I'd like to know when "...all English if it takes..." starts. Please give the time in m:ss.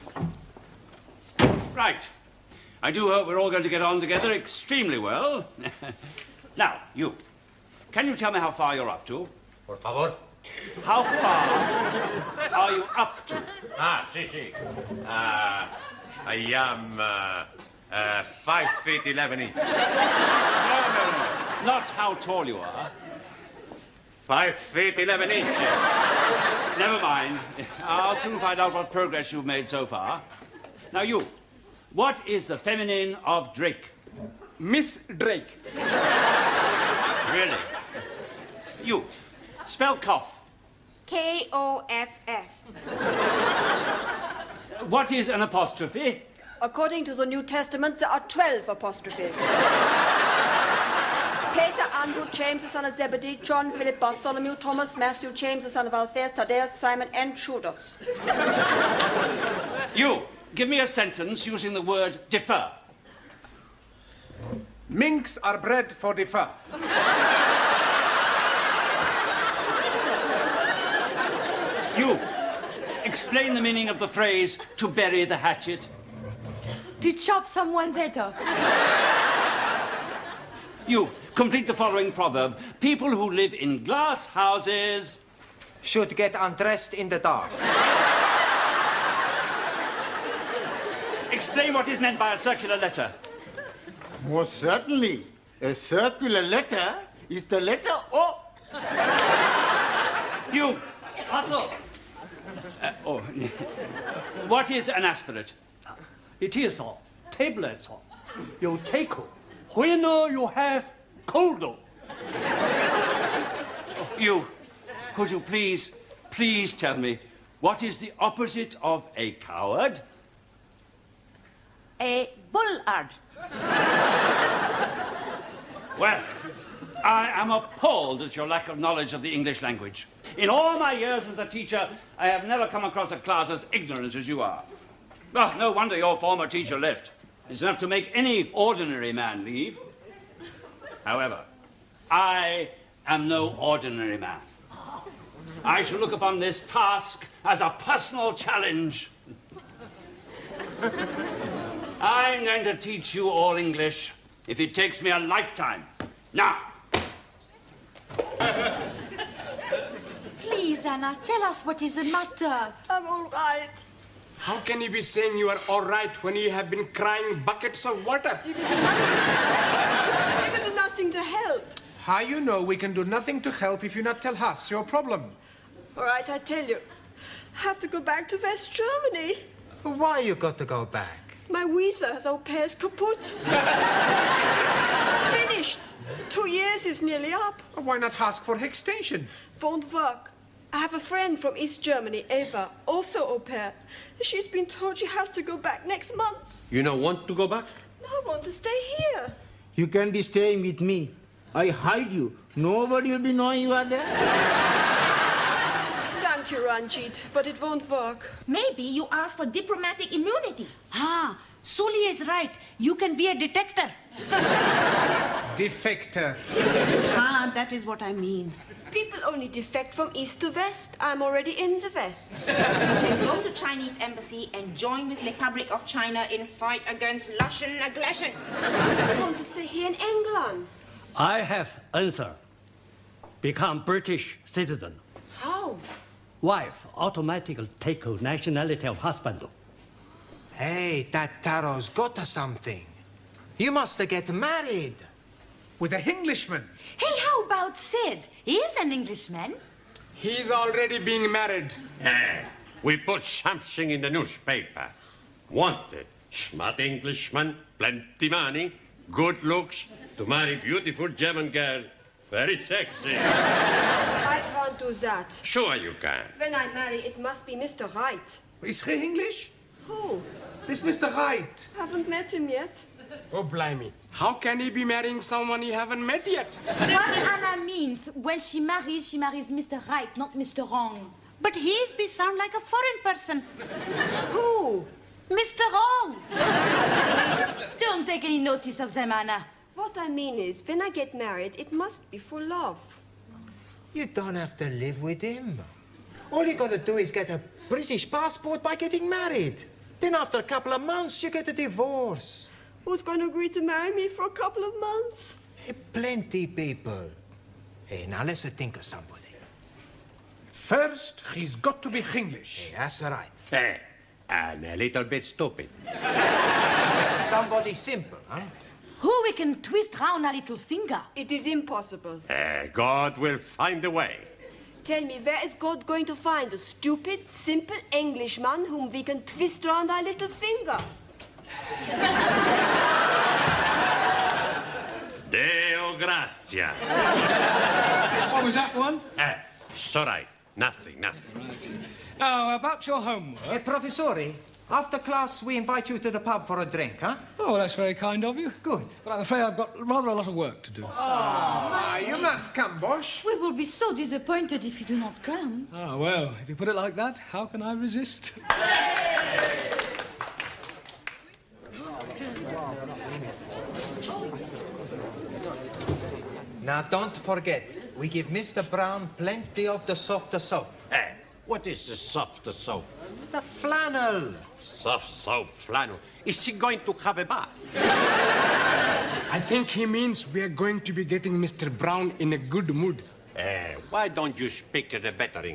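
2:33.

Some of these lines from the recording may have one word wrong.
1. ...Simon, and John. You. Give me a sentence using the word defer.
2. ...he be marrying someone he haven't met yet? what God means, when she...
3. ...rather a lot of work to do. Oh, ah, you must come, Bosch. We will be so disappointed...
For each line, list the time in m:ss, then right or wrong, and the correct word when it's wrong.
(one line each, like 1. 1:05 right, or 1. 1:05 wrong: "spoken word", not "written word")
1. 0:56 wrong: "Judas", not "John"
2. 4:34 wrong: "Anna", not "God"
3. 5:49 right.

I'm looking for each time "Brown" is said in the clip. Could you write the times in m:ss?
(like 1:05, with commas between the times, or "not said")
6:08, 6:21.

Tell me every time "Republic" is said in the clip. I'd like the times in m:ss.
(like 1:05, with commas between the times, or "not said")
3:45.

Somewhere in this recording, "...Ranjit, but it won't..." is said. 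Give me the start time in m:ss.
3:26.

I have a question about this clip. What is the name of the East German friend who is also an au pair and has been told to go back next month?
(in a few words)
Eva.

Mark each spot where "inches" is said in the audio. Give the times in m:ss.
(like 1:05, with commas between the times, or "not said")
0:19, 0:25.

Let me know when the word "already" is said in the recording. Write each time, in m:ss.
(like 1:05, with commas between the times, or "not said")
3:41, 4:10.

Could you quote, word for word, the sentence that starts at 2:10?
In all my years as a teacher, I have never come across a class as ignorant as you are.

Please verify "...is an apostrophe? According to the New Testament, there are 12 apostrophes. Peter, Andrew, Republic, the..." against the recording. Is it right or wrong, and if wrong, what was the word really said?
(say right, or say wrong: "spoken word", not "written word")
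wrong: "James", not "Republic".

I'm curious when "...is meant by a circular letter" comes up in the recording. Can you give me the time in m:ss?
1:31.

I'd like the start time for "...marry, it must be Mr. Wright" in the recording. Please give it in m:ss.
4:26.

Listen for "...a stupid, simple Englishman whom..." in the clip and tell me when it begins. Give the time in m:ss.
5:26.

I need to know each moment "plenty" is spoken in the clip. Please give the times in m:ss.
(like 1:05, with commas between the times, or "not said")
4:17, 5:05, 6:09.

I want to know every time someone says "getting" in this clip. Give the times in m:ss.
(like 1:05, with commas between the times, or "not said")
4:58, 6:21.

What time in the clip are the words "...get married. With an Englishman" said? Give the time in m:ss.
4:04.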